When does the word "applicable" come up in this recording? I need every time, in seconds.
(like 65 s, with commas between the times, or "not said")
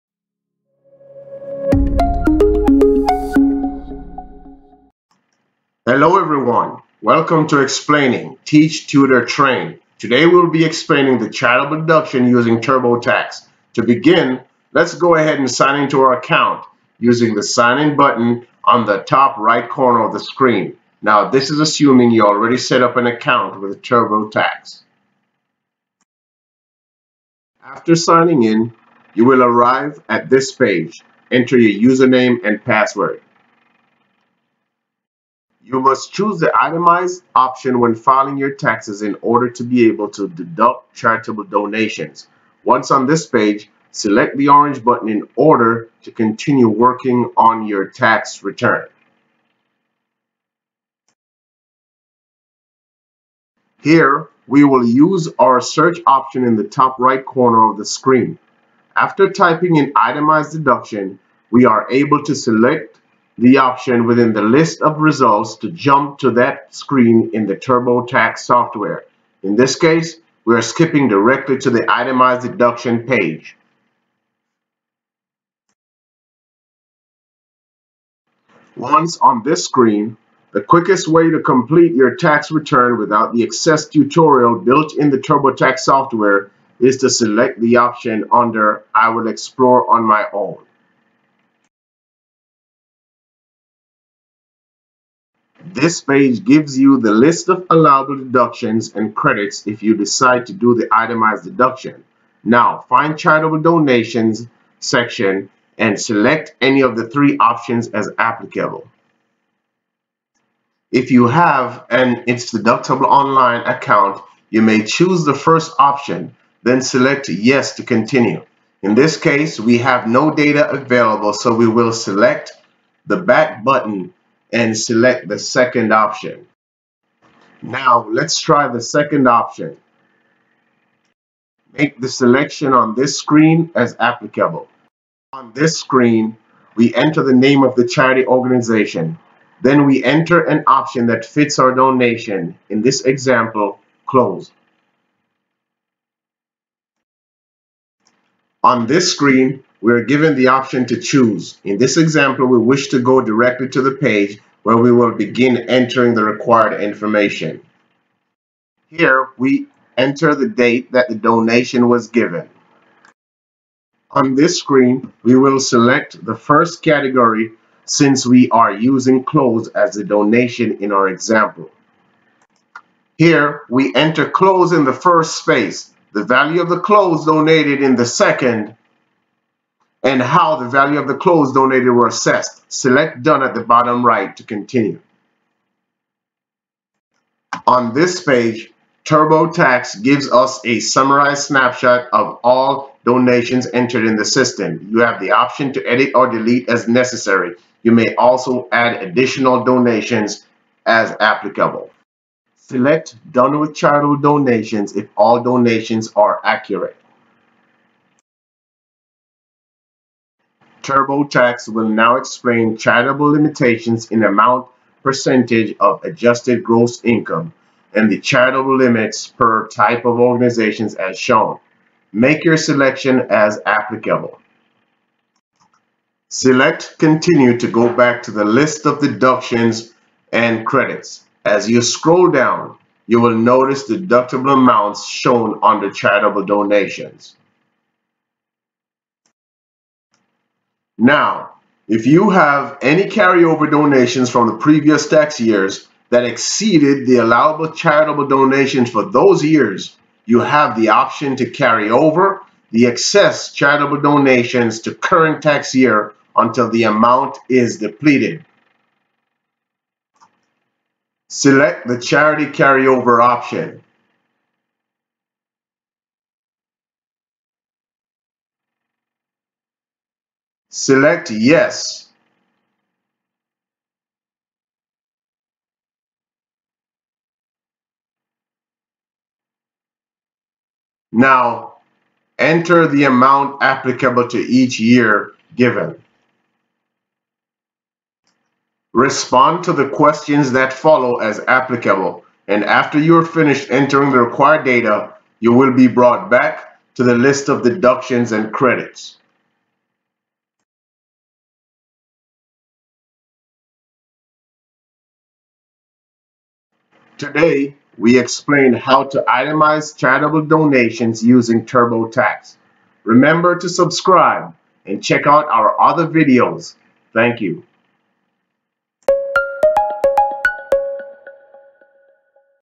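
108 s, 133 s, 201 s, 223 s, 283 s, 291 s.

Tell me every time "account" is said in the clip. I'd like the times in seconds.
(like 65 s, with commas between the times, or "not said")
16 s, 23 s, 113 s.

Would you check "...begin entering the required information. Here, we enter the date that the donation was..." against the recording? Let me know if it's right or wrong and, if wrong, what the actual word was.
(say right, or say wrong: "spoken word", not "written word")
right.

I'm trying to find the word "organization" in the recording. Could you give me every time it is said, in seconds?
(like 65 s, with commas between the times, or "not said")
138 s, 220 s.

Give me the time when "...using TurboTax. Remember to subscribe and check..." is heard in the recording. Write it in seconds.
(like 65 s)
311 s.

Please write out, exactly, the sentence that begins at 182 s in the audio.
Select Done at the bottom right to continue.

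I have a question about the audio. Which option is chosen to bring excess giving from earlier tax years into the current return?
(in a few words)
charity carryover.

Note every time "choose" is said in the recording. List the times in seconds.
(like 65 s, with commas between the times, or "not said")
36 s, 114 s, 150 s.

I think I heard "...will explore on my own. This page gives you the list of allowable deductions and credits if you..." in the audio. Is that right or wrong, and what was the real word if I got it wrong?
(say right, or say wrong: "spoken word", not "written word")
right.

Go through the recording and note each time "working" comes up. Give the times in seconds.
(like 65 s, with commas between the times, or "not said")
46 s.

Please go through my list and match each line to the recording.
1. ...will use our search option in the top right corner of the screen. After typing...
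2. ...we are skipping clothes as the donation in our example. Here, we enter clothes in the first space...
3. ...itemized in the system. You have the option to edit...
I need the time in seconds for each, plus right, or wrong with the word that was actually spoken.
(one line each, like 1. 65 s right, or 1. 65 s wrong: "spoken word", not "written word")
1. 54 s right
2. 168 s wrong: "using", not "skipping"
3. 193 s wrong: "entered", not "itemized".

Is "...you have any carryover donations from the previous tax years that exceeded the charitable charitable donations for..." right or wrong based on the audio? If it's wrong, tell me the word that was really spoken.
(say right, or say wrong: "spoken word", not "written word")
wrong: "allowable", not "charitable".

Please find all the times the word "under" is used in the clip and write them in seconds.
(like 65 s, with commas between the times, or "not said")
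88 s, 235 s.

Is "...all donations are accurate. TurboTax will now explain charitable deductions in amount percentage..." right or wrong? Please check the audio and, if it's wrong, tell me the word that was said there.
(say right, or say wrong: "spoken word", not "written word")
wrong: "limitations", not "deductions".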